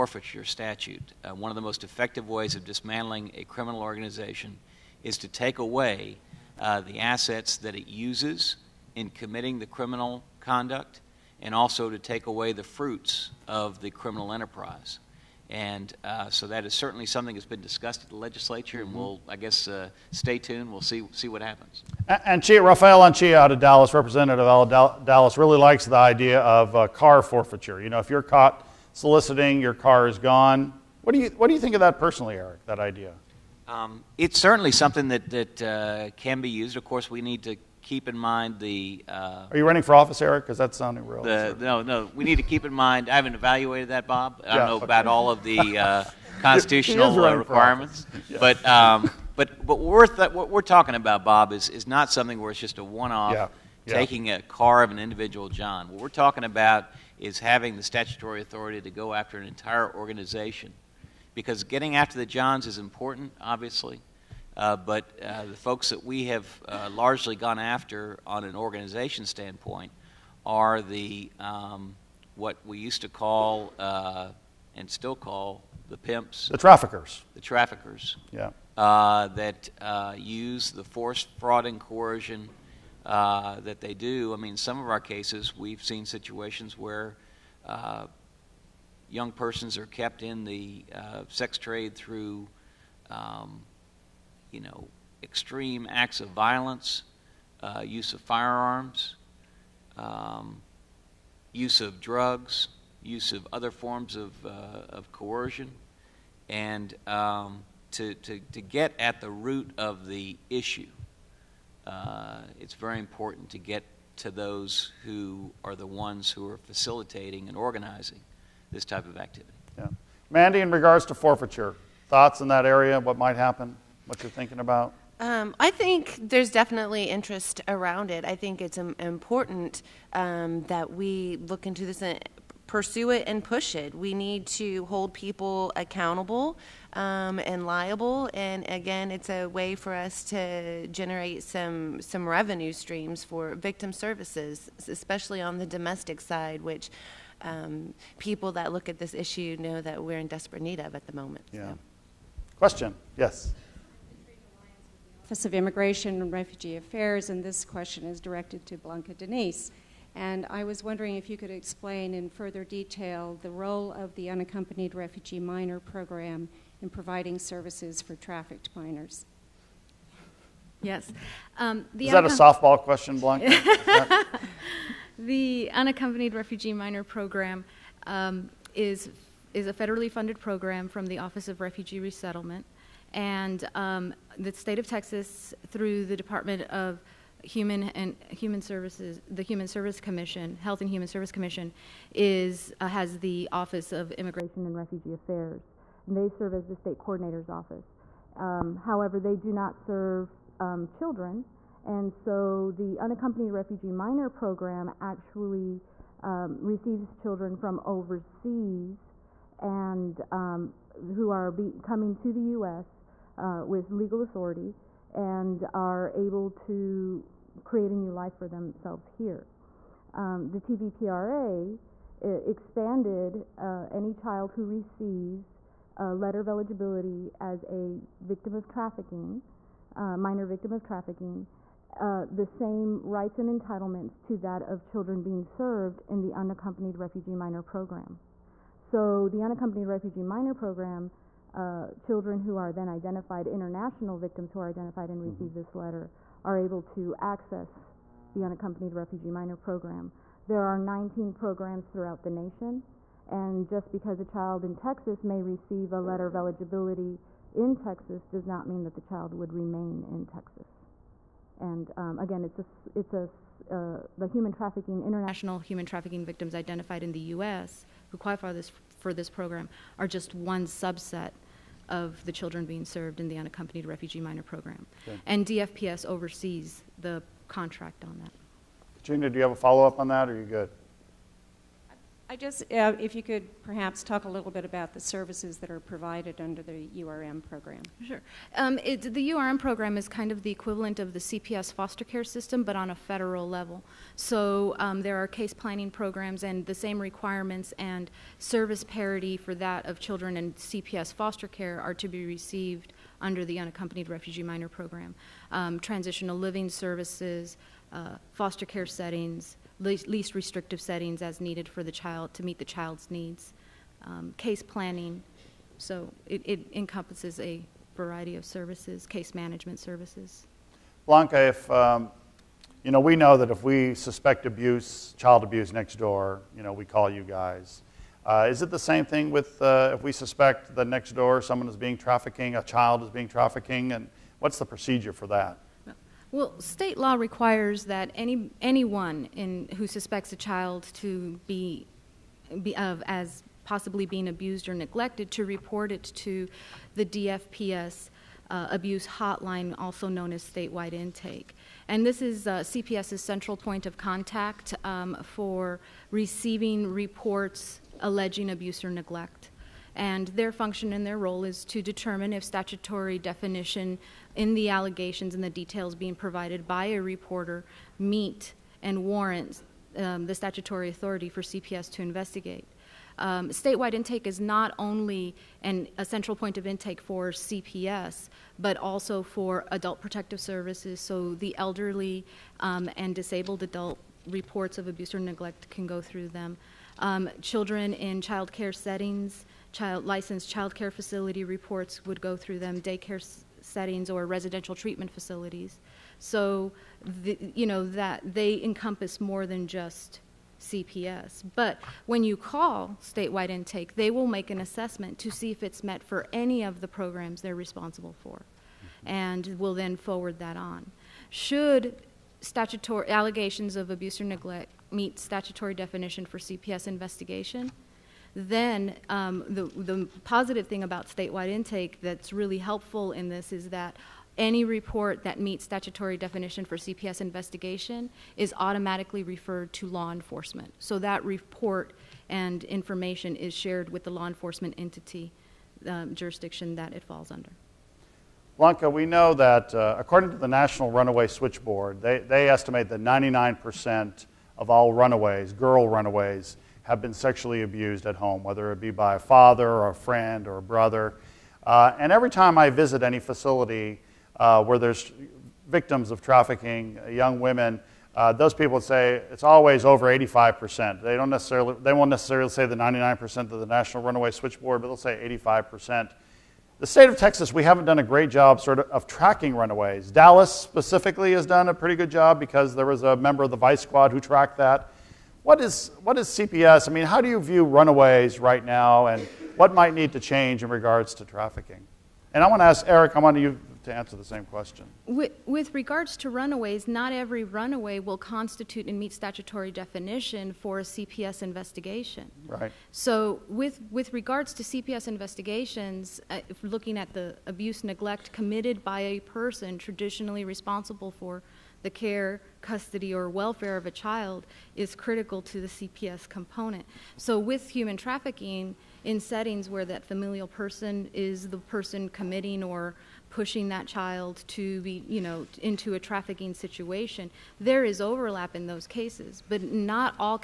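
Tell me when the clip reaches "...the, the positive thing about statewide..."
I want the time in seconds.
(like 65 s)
419 s.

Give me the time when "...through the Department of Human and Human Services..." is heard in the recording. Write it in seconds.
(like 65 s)
185 s.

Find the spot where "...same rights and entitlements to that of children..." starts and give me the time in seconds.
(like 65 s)
232 s.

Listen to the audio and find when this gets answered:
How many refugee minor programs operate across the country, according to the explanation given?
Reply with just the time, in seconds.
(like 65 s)
250 s.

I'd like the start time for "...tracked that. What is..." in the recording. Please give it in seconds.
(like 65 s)
474 s.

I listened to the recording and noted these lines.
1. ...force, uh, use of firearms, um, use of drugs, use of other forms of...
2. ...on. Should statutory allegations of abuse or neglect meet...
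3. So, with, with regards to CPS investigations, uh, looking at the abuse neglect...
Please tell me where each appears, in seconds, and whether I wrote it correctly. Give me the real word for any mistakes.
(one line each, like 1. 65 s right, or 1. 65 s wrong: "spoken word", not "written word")
1. 96 s wrong: "violence", not "force"
2. 410 s right
3. 492 s right.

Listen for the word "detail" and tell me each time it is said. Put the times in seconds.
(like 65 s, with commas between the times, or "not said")
162 s, 365 s.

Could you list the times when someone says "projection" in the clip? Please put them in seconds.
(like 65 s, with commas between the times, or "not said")
not said.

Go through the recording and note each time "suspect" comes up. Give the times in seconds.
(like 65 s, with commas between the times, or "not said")
323 s, 330 s, 339 s.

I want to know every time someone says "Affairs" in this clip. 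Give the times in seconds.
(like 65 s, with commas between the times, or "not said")
156 s, 195 s.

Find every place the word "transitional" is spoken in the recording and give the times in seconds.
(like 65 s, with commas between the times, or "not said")
305 s.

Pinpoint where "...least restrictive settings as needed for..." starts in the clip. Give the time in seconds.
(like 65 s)
309 s.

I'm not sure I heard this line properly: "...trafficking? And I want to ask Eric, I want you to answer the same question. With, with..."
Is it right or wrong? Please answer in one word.
right.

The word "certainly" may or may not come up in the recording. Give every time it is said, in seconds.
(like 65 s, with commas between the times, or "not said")
16 s, 34 s.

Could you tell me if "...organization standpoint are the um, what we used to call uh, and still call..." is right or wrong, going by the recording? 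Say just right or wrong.
right.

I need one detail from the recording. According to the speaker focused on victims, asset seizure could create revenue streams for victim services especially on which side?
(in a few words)
Domestic.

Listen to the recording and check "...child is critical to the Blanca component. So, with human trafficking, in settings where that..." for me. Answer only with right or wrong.
wrong.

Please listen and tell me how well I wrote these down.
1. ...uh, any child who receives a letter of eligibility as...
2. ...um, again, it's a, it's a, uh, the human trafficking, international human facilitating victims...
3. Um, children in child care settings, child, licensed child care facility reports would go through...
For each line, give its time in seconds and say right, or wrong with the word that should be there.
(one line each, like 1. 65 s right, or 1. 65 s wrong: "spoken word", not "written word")
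1. 223 s right
2. 261 s wrong: "trafficking", not "facilitating"
3. 386 s right.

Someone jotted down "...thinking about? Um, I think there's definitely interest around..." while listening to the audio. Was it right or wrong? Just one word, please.
right.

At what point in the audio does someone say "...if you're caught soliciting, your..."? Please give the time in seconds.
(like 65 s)
28 s.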